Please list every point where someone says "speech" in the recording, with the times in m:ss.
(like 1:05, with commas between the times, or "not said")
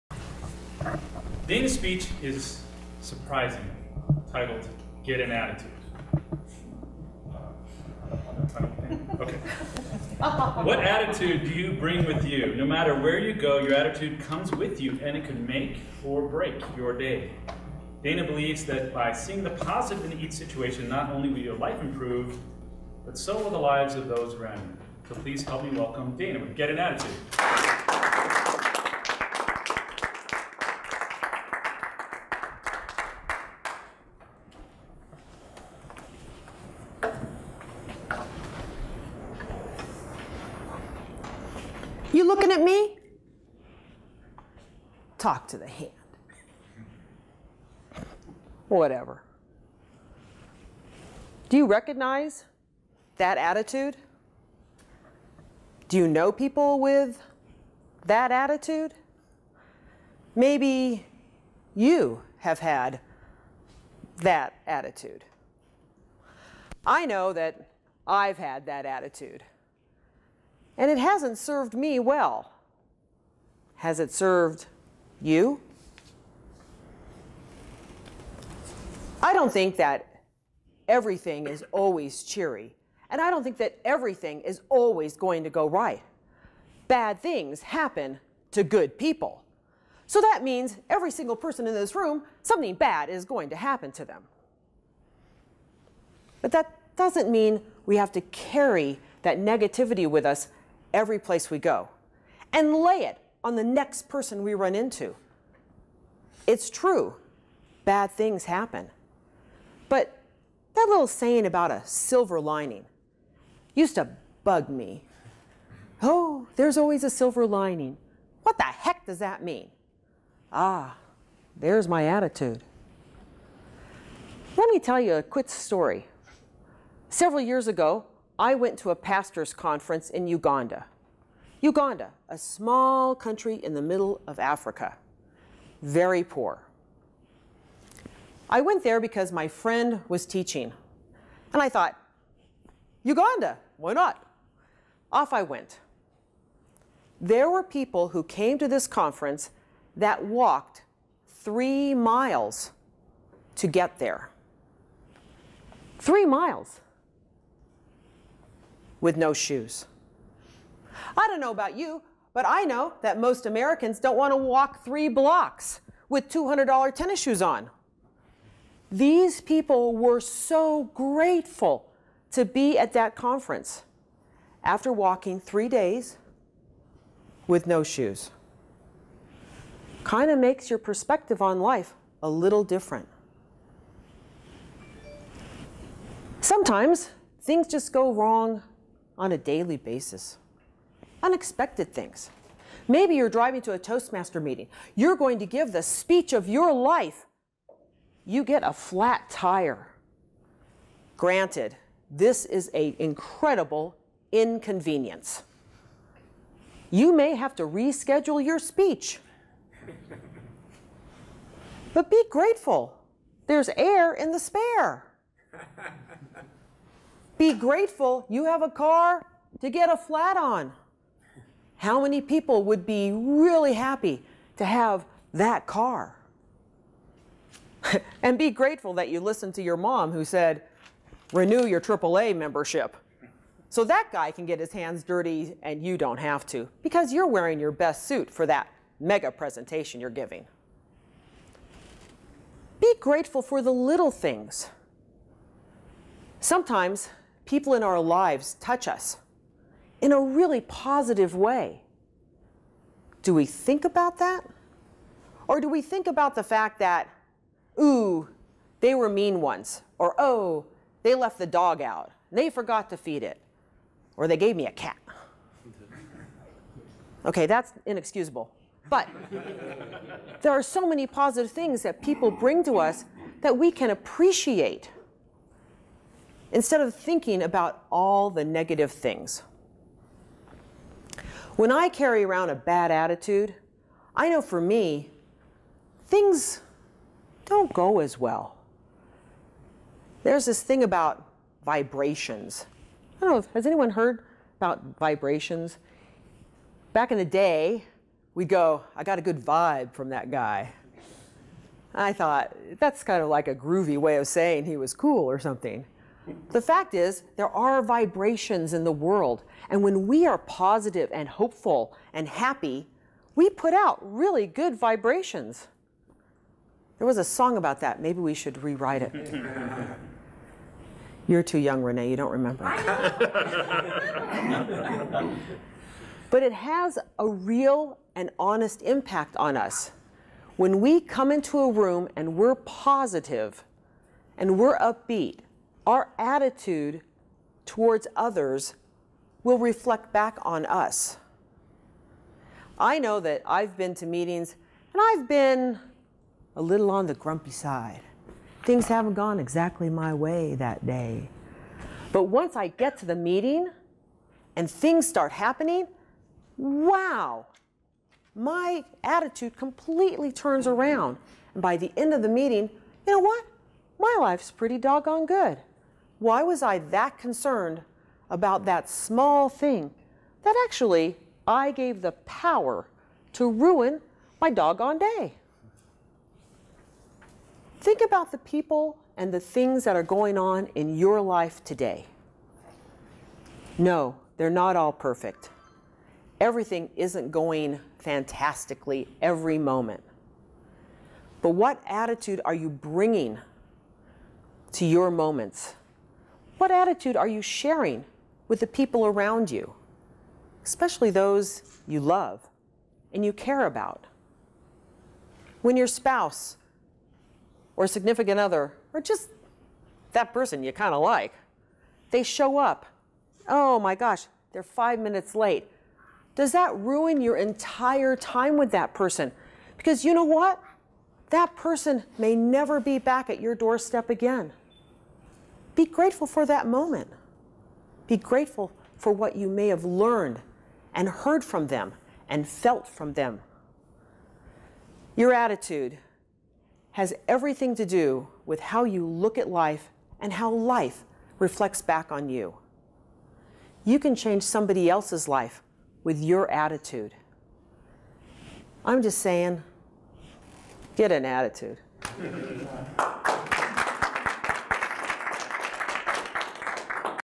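0:01, 3:15, 3:28.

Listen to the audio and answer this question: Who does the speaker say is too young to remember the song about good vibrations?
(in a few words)
Renee.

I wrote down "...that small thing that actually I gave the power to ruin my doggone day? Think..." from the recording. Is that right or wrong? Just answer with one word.
right.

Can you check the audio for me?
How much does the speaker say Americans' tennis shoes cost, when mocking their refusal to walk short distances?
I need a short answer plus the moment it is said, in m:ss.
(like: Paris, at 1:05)
$200, at 2:46.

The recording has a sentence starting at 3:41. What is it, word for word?
How many people would be really happy to have that car?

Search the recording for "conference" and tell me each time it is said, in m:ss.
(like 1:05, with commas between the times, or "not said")
2:09, 2:28, 2:53.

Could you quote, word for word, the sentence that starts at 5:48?
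Things haven't gone exactly my way that day.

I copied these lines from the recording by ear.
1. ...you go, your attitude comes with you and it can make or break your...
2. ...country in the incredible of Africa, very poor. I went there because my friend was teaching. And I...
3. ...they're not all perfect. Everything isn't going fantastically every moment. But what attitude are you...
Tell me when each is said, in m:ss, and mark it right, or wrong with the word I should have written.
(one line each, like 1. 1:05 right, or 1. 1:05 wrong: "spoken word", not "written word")
1. 0:13 right
2. 2:13 wrong: "middle", not "incredible"
3. 6:24 right.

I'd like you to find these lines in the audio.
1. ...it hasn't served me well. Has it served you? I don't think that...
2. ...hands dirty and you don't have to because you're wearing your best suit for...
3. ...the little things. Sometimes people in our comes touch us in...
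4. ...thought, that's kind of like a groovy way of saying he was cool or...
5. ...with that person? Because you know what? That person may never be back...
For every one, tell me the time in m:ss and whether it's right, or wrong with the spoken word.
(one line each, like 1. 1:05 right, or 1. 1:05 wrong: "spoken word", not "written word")
1. 1:10 right
2. 3:54 right
3. 4:03 wrong: "lives", not "comes"
4. 5:02 right
5. 6:58 right.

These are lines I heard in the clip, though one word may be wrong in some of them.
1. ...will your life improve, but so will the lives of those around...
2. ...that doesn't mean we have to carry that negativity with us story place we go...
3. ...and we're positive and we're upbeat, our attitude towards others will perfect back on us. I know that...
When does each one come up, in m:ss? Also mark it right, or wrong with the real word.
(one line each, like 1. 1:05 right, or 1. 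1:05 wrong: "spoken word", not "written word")
1. 0:21 right
2. 1:36 wrong: "every", not "story"
3. 5:32 wrong: "reflect", not "perfect".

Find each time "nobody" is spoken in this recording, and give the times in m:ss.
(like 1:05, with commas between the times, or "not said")
not said.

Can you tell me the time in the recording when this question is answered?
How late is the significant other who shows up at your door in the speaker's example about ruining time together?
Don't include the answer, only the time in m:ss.
6:54.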